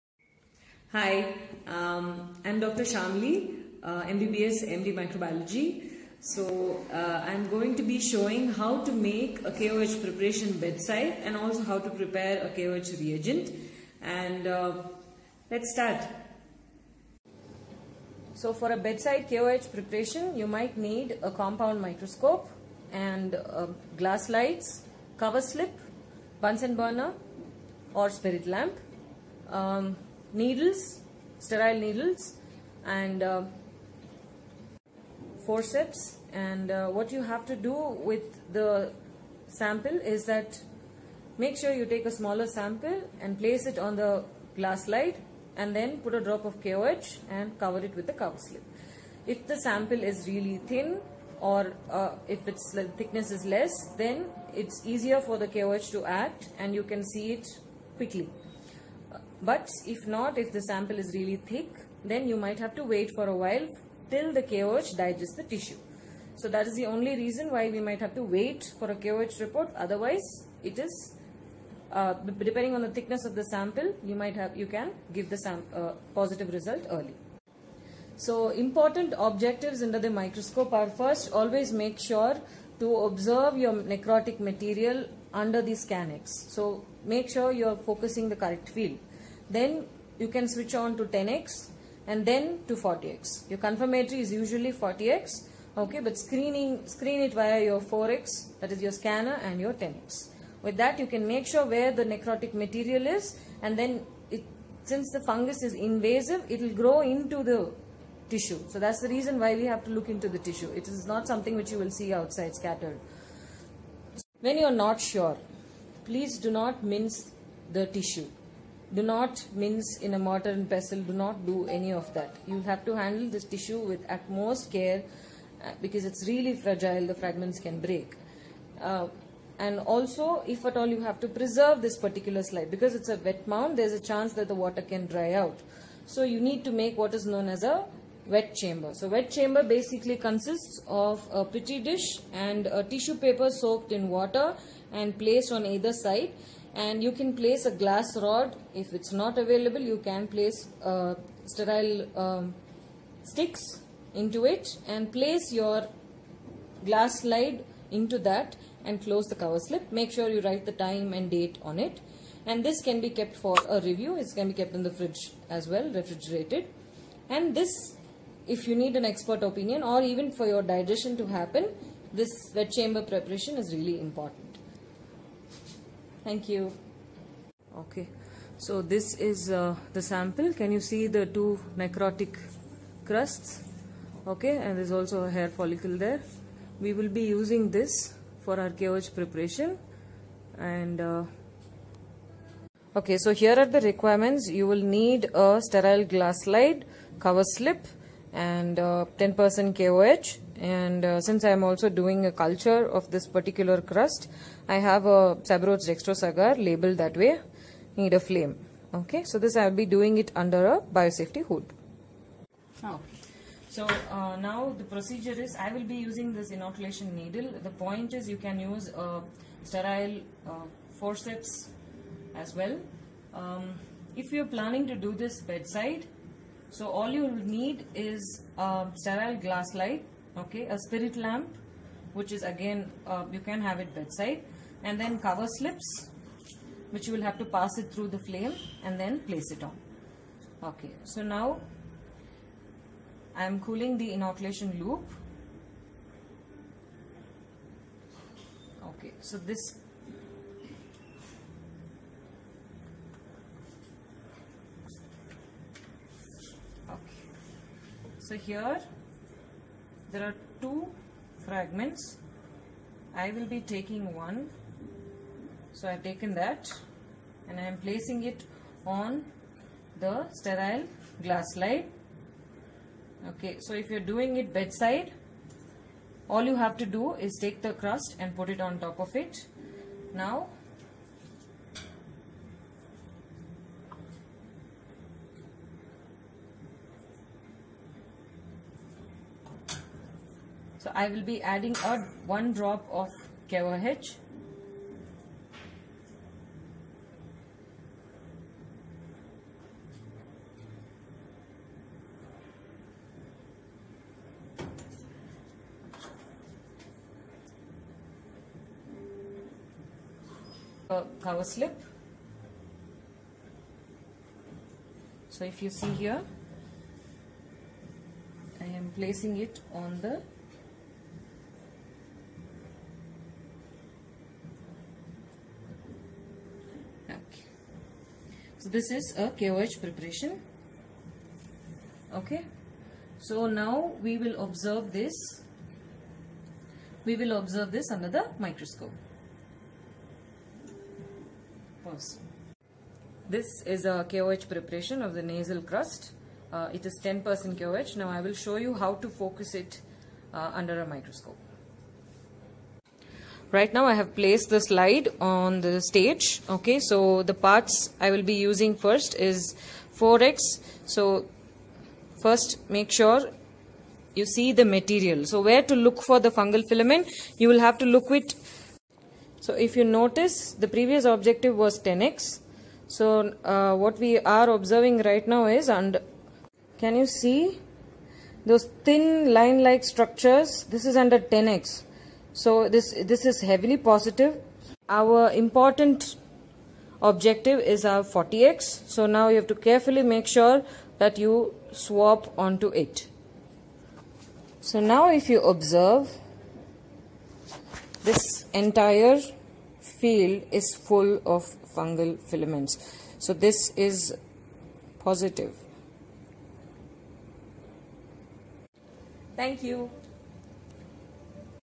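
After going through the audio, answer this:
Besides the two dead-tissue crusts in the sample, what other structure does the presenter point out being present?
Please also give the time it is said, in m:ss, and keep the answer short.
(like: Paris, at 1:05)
a hair follicle, at 3:05.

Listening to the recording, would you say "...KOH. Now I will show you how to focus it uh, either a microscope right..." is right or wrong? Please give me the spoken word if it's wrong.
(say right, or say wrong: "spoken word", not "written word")
wrong: "under", not "either".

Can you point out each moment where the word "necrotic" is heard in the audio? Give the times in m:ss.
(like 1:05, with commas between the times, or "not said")
1:23, 1:42, 3:01.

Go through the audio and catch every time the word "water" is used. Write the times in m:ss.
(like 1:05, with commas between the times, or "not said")
2:14, 2:24.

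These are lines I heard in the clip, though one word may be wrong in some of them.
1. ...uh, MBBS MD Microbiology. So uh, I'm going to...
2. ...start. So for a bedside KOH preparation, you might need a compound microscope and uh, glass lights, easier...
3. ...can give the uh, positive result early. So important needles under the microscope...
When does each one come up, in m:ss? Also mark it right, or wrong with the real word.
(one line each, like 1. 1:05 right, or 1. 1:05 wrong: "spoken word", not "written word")
1. 0:03 right
2. 0:15 wrong: "cover", not "easier"
3. 1:14 wrong: "objectives", not "needles".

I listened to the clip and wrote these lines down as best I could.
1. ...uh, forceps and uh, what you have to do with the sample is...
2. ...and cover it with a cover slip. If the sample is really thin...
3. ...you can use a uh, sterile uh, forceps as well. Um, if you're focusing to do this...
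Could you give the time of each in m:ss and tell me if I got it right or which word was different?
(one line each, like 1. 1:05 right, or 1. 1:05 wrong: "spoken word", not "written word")
1. 0:33 right
2. 0:47 right
3. 3:38 wrong: "planning", not "focusing".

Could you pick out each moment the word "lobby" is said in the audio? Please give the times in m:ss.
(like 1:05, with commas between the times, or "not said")
not said.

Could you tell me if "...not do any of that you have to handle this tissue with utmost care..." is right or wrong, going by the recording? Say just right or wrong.
right.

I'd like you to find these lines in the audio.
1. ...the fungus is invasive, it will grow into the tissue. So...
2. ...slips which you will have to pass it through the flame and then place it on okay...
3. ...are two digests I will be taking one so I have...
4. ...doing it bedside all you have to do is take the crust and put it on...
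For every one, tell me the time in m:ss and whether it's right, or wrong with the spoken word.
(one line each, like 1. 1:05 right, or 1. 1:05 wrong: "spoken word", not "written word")
1. 1:45 right
2. 3:55 right
3. 4:20 wrong: "fragments", not "digests"
4. 4:34 right.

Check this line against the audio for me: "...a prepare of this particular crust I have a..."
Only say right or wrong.
wrong.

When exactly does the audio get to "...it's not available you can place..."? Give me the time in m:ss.
2:28.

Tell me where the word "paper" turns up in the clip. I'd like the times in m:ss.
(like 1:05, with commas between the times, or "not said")
2:23.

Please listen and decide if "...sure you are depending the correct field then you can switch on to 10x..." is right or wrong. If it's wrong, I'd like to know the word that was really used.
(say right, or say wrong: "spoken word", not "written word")
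wrong: "focusing", not "depending".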